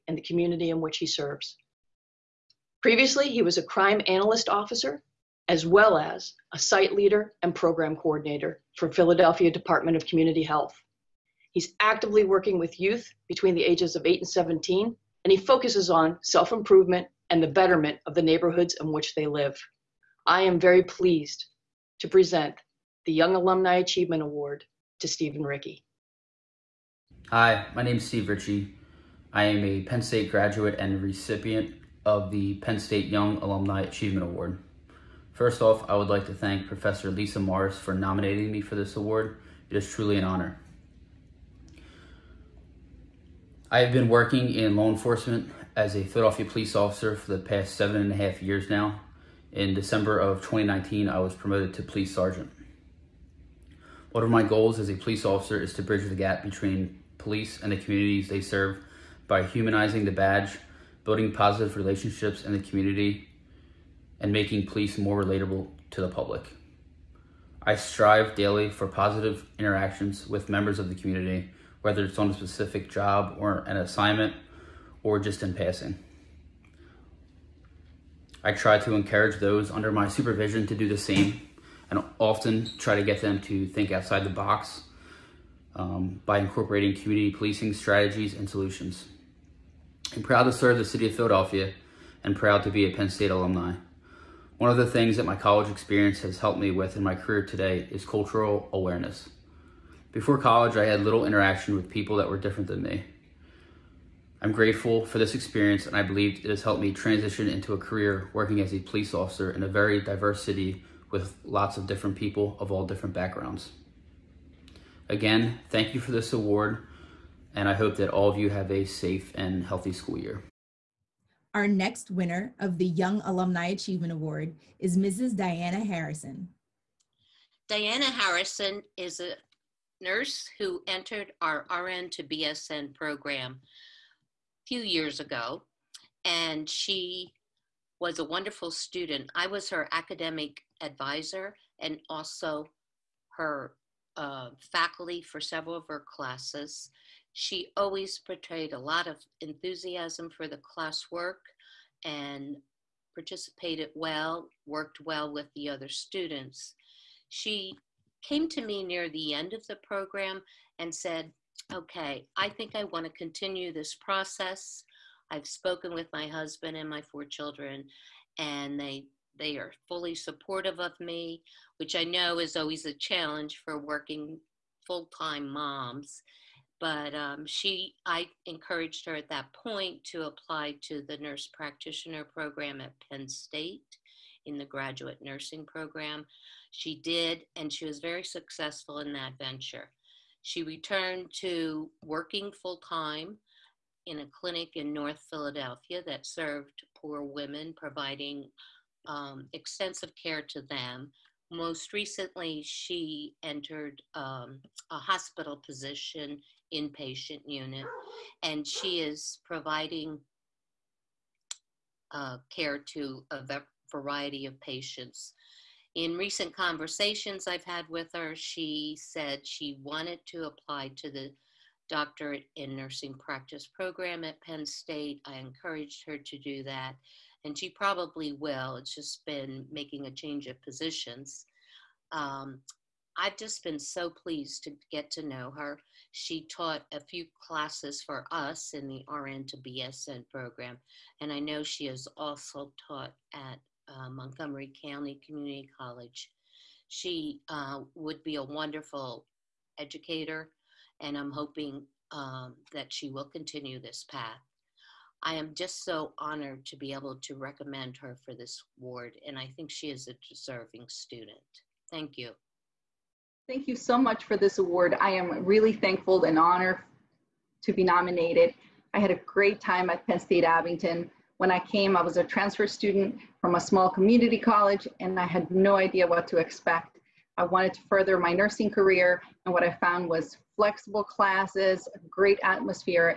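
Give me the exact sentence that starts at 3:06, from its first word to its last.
She did, and she was very successful in that venture.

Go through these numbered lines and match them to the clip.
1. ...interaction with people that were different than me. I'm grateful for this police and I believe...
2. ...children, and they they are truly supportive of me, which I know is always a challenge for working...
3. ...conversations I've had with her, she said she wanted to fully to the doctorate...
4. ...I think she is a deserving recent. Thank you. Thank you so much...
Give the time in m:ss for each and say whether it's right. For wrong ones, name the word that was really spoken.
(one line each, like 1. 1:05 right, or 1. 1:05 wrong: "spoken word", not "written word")
1. 1:41 wrong: "experience", not "police"
2. 2:47 wrong: "fully", not "truly"
3. 3:36 wrong: "apply", not "fully"
4. 4:19 wrong: "student", not "recent".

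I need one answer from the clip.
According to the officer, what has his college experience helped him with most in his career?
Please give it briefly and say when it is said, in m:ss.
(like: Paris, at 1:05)
Cultural awareness, at 1:38.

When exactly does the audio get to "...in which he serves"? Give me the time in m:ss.
0:00.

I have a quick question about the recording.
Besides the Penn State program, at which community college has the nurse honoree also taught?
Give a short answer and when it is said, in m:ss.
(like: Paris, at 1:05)
Montgomery County Community College, at 4:04.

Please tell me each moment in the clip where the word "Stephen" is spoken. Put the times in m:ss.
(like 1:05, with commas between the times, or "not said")
0:25.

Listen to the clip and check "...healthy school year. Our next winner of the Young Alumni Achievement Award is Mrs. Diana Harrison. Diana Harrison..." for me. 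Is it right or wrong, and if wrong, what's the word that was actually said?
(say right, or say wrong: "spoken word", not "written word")
right.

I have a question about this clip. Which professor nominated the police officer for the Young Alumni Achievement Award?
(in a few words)
Lisa Morris.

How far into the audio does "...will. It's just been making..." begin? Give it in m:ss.
3:48.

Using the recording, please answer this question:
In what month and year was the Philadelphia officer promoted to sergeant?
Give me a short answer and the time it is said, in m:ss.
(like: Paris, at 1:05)
December 2019, at 0:49.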